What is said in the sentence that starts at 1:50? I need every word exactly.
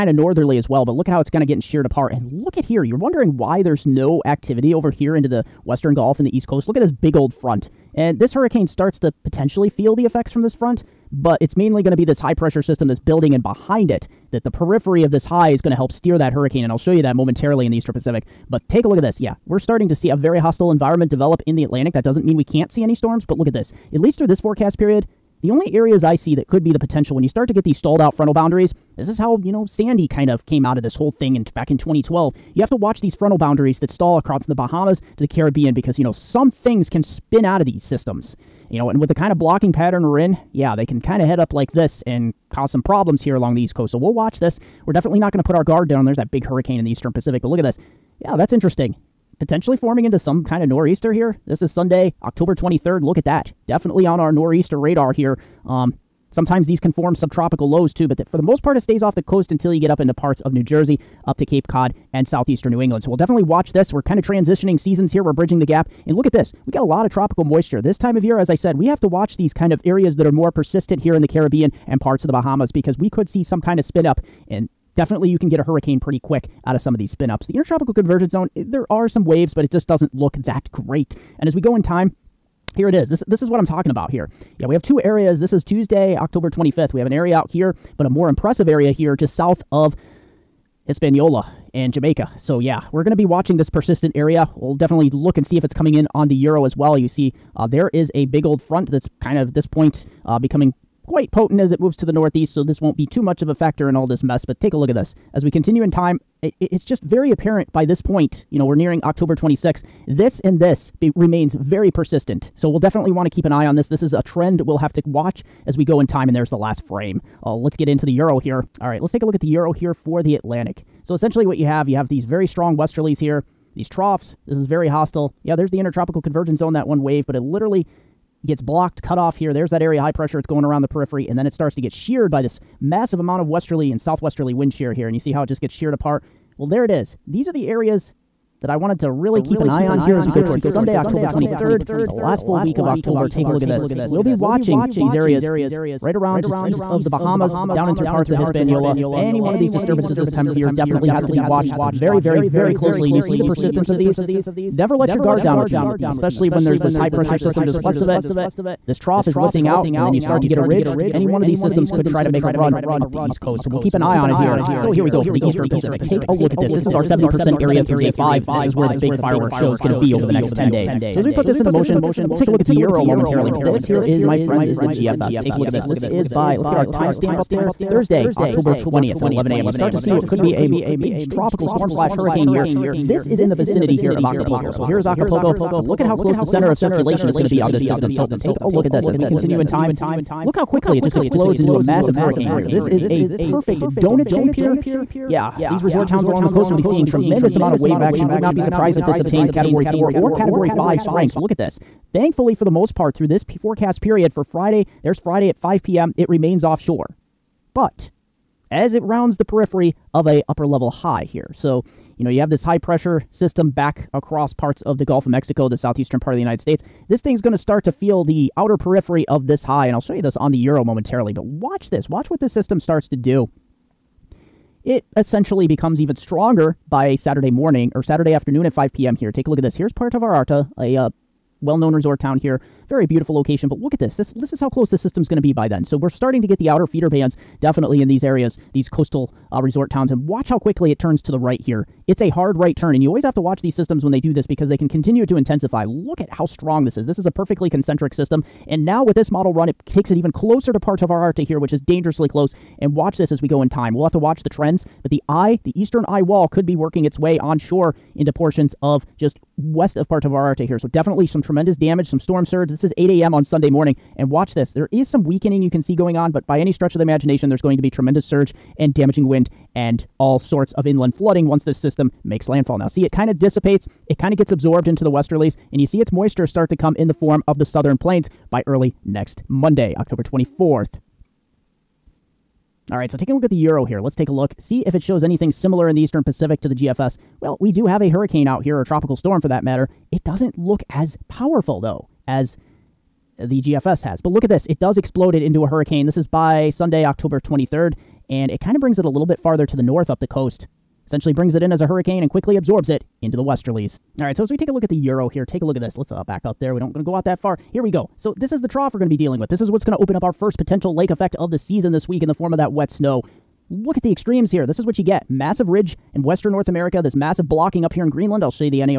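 This and this be, remains very persistent.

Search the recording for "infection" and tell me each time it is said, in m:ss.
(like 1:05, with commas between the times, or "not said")
not said.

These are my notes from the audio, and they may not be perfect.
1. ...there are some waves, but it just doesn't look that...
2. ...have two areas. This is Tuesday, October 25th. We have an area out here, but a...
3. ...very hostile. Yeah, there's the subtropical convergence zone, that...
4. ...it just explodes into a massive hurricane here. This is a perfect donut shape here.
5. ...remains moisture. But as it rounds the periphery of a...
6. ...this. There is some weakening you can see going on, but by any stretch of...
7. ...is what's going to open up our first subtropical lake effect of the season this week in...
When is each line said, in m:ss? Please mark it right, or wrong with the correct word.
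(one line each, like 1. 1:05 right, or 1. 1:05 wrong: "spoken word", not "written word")
1. 1:18 right
2. 1:24 right
3. 2:04 wrong: "intertropical", not "subtropical"
4. 3:10 right
5. 3:26 wrong: "offshore", not "moisture"
6. 4:24 right
7. 5:09 wrong: "potential", not "subtropical".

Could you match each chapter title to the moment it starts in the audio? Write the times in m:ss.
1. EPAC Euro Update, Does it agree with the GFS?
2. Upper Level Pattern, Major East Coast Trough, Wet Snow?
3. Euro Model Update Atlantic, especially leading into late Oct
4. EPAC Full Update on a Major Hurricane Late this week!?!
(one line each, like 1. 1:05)
1. 4:41
2. 5:04
3. 1:58
4. 2:44.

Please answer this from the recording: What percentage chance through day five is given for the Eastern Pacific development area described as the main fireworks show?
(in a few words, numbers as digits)
70%.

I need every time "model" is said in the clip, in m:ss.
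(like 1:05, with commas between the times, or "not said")
4:09.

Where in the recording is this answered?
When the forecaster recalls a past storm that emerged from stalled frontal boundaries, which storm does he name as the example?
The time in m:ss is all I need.
0:29.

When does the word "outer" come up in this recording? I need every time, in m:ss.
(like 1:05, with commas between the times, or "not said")
3:38, 3:56.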